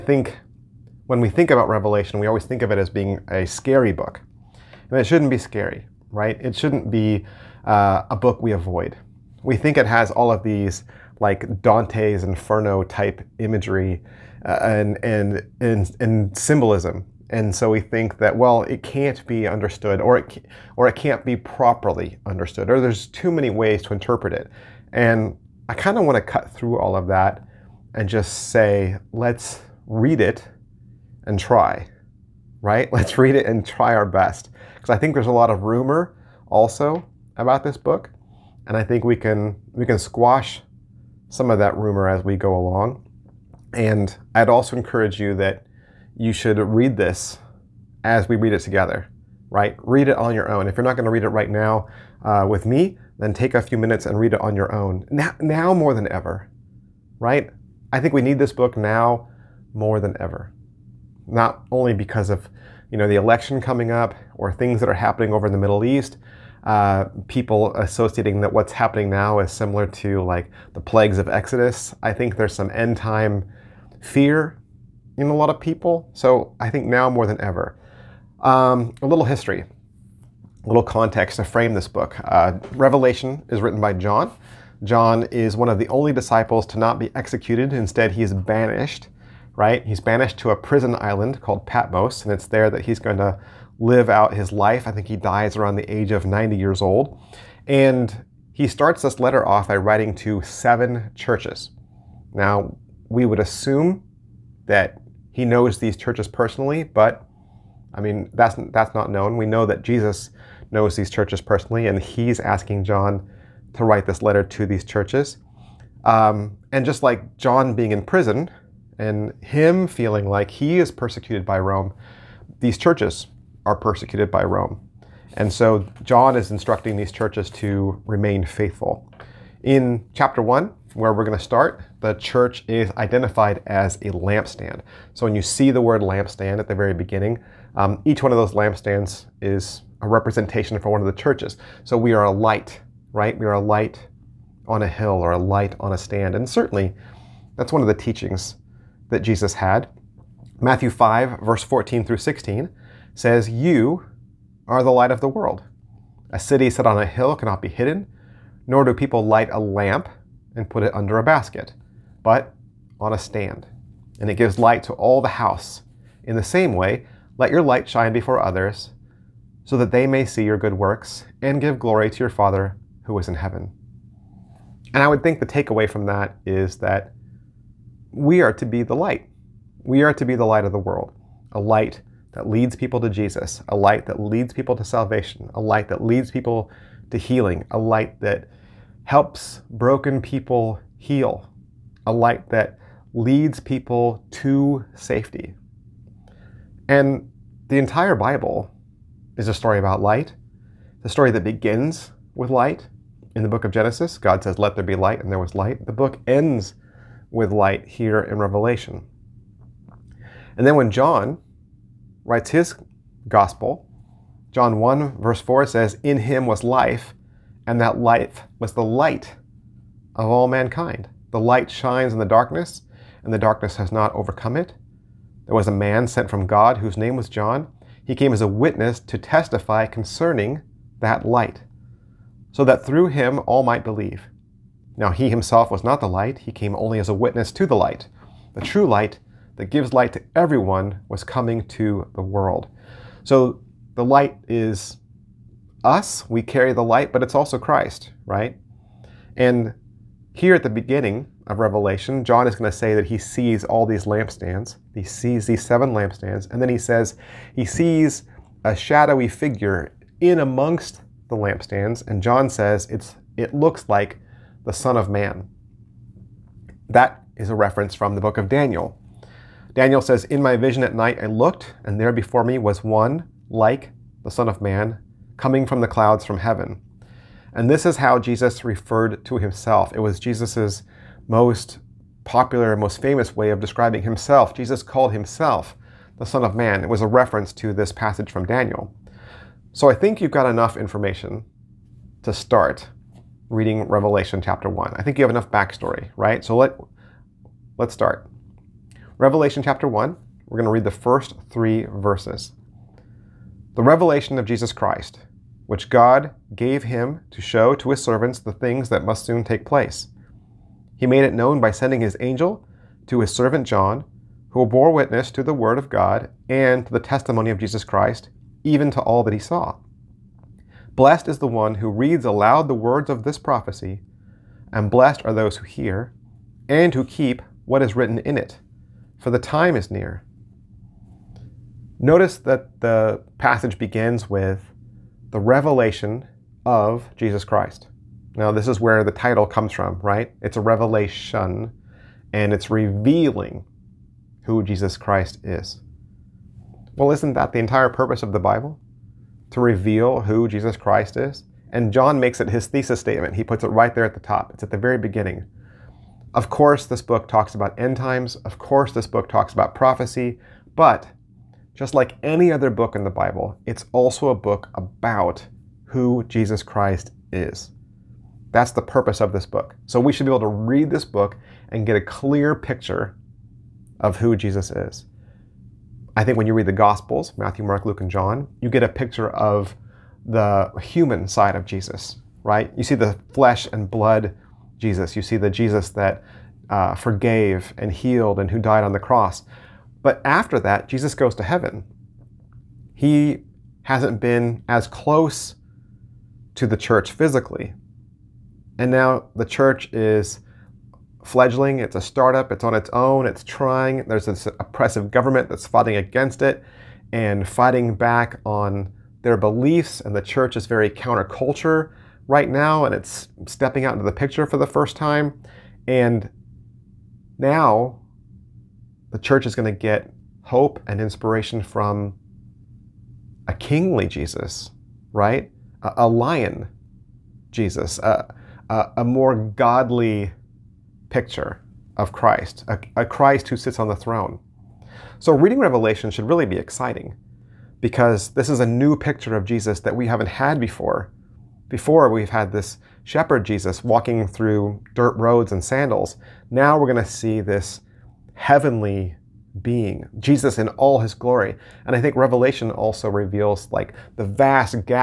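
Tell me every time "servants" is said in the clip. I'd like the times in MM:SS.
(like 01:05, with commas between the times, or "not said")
05:08, 05:13.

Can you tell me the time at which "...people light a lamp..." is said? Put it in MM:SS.
02:38.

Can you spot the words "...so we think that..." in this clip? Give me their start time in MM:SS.
00:17.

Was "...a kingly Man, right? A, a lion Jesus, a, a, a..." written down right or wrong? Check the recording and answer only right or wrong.
wrong.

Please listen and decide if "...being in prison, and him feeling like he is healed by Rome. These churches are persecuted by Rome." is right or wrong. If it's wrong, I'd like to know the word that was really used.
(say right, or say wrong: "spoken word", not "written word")
wrong: "persecuted", not "healed".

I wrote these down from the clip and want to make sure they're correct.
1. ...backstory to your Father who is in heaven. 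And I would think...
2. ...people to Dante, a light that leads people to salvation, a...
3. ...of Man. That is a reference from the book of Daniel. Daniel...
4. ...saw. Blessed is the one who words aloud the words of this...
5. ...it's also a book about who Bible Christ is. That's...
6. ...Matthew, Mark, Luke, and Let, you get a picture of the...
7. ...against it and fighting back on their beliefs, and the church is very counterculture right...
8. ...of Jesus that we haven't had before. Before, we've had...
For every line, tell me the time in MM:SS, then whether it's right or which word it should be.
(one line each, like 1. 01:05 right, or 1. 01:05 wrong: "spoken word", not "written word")
1. 02:51 wrong: "glory", not "backstory"
2. 03:02 wrong: "Jesus", not "Dante"
3. 04:24 right
4. 05:19 wrong: "reads", not "words"
5. 06:03 wrong: "Jesus", not "Bible"
6. 06:17 wrong: "John", not "Let"
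7. 06:45 right
8. 07:19 right.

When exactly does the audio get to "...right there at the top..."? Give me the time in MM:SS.
05:53.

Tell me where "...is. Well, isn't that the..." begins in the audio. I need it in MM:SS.
05:45.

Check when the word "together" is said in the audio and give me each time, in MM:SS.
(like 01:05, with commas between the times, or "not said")
00:48.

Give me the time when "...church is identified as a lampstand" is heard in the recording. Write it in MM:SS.
02:12.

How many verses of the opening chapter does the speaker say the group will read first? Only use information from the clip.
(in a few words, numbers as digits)
3.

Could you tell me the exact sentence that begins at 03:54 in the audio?
Now he himself was not the light, he came only as a witness to the light.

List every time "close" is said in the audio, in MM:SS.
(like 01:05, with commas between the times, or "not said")
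06:34.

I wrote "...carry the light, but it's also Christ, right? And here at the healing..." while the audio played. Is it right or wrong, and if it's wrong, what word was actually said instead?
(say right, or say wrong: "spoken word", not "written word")
wrong: "beginning", not "healing".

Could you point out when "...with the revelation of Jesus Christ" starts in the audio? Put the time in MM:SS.
05:34.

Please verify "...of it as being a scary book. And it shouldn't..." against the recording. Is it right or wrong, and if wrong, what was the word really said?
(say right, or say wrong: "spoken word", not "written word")
right.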